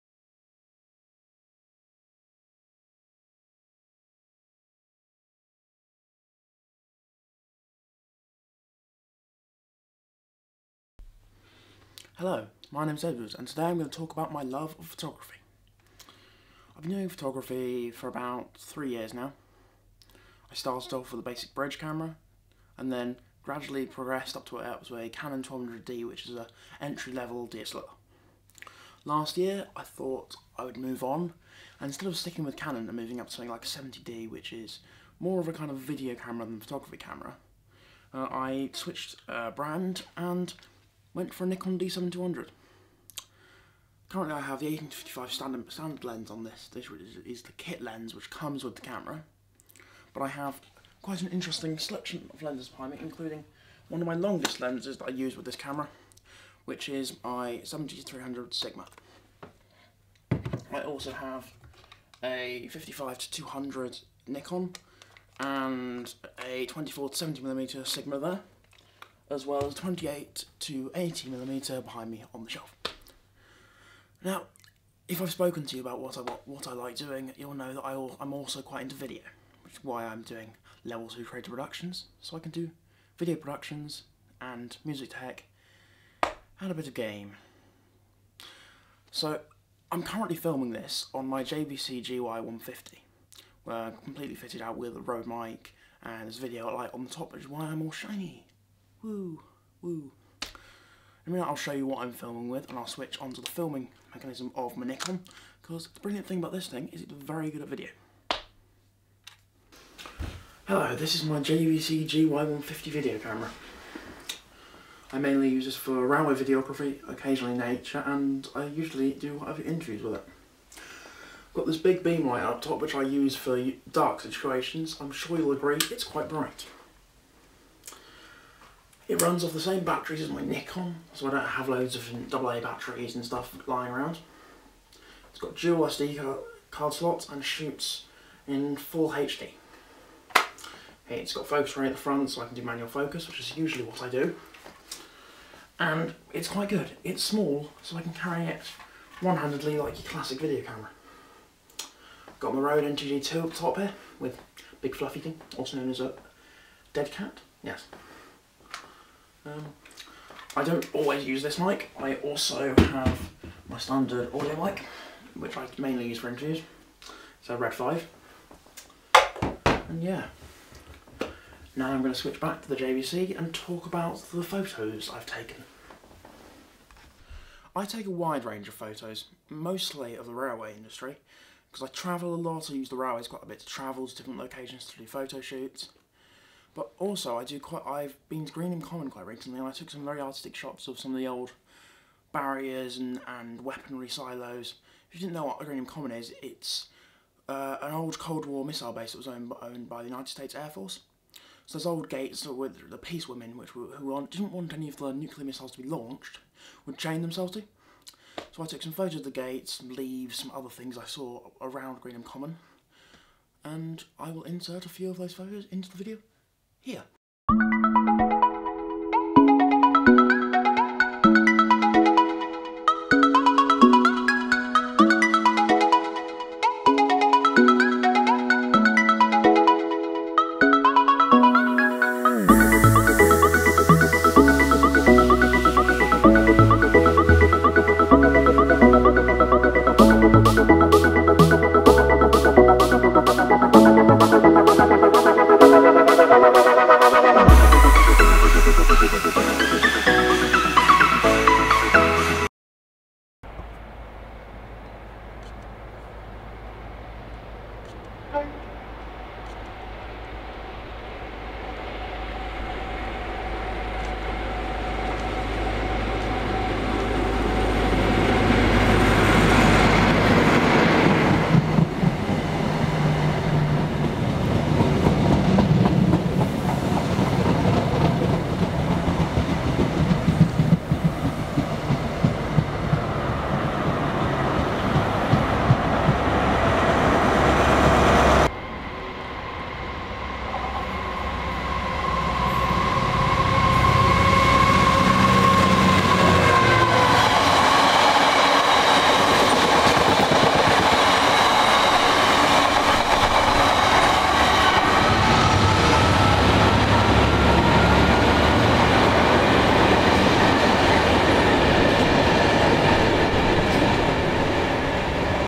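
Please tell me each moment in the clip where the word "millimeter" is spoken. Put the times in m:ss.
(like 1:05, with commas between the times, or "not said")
1:11.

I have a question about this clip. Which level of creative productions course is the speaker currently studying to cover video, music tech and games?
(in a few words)
Level 2.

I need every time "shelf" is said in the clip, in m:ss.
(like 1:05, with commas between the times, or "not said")
1:12.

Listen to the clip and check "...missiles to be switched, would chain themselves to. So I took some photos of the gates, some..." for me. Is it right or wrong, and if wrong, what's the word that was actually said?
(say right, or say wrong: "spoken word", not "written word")
wrong: "launched", not "switched".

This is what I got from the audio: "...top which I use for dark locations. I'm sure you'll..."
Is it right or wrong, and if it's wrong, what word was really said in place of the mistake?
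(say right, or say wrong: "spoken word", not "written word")
wrong: "situations", not "locations".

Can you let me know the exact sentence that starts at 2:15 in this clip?
It's got dual SD card slots and shoots in full HD.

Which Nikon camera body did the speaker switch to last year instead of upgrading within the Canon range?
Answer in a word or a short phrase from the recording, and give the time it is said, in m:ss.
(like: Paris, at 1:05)
Nikon D7200, at 0:41.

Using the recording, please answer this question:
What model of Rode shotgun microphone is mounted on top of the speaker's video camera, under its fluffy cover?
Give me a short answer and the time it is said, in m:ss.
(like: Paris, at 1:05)
NTG2, at 2:32.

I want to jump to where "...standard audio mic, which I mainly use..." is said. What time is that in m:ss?
2:43.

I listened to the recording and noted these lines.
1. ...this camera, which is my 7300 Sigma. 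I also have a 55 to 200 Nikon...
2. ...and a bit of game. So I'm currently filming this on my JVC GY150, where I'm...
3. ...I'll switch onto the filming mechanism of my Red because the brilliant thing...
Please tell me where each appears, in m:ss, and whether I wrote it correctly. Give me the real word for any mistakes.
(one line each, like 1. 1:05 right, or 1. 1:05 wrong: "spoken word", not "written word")
1. 0:55 right
2. 1:26 right
3. 1:42 wrong: "Nikon", not "Red".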